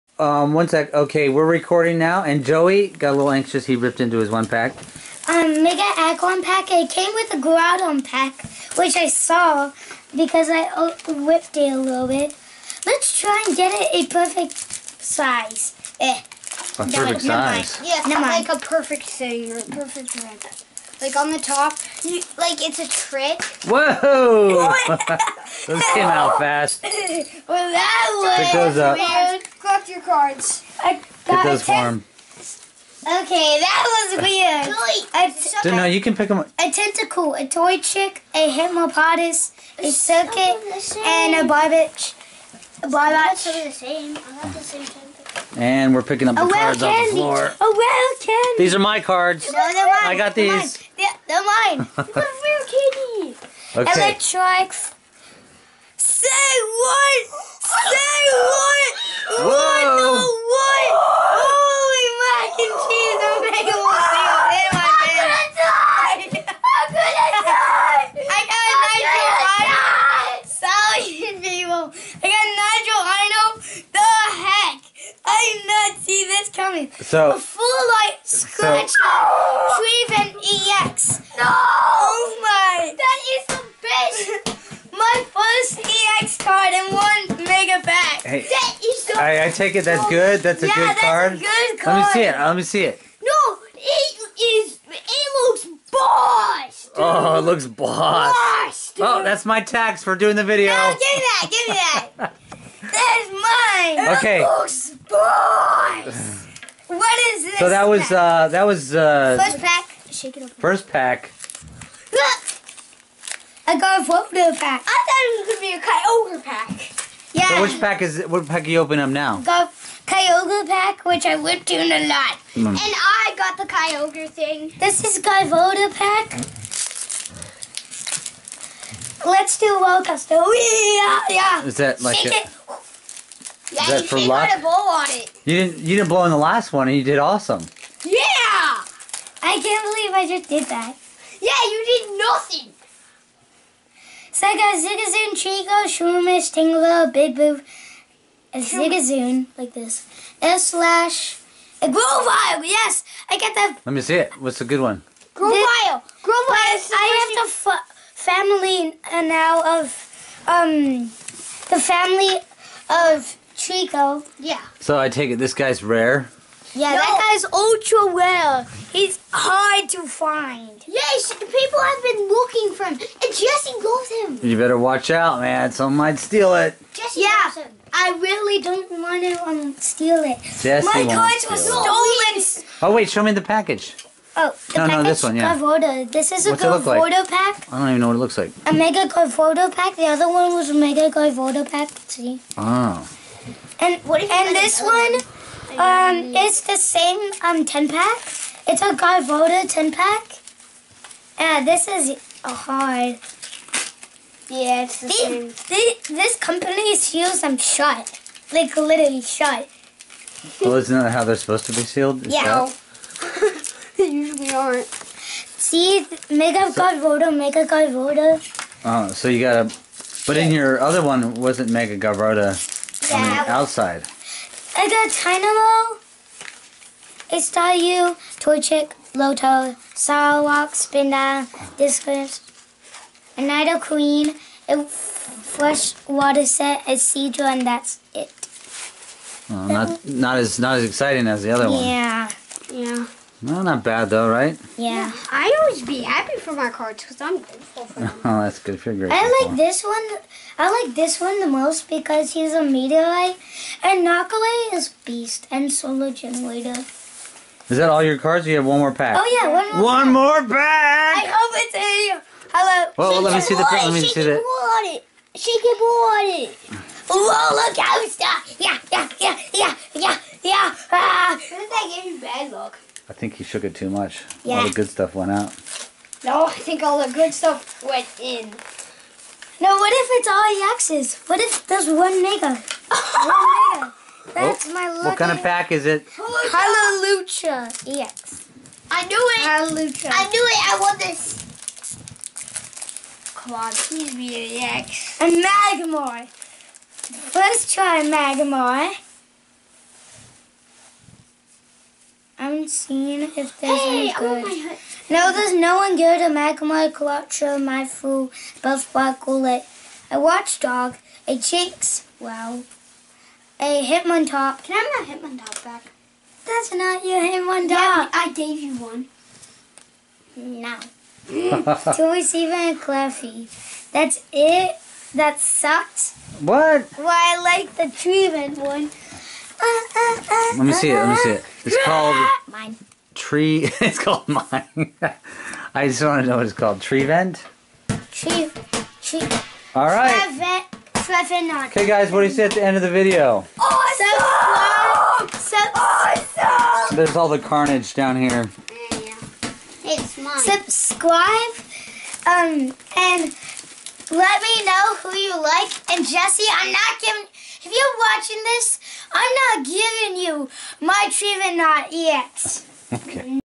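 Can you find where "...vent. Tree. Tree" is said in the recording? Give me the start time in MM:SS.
05:37.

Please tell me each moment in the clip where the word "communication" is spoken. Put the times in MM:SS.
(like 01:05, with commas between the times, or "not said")
not said.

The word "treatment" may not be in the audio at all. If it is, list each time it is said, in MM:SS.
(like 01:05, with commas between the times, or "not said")
05:27, 06:01.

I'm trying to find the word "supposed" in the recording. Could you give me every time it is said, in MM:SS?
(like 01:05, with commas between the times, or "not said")
03:31.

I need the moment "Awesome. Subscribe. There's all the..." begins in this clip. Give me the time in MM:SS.
05:43.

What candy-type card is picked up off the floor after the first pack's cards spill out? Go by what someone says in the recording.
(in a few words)
A whale candy.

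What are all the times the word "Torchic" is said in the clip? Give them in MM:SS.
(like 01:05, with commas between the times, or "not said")
00:37, 03:48.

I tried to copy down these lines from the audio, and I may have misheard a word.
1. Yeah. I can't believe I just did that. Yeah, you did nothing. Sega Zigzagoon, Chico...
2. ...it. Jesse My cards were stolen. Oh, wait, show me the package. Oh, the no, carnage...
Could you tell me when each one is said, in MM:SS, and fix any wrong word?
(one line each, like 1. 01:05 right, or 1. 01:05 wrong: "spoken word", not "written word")
1. 02:18 right
2. 03:00 wrong: "package", not "carnage".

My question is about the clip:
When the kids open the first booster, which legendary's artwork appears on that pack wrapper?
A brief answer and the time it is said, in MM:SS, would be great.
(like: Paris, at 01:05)
Groudon, at 00:07.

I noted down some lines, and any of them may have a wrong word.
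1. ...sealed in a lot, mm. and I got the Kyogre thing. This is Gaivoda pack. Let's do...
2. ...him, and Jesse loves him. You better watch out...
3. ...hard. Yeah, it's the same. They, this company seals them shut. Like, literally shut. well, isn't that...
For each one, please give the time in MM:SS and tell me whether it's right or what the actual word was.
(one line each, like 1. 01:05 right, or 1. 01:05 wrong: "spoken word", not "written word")
1. 02:01 wrong: "whipped", not "sealed"
2. 02:52 right
3. 03:22 right.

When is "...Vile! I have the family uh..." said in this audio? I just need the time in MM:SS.
02:36.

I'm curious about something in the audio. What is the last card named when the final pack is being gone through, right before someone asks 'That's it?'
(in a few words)
Cleffy.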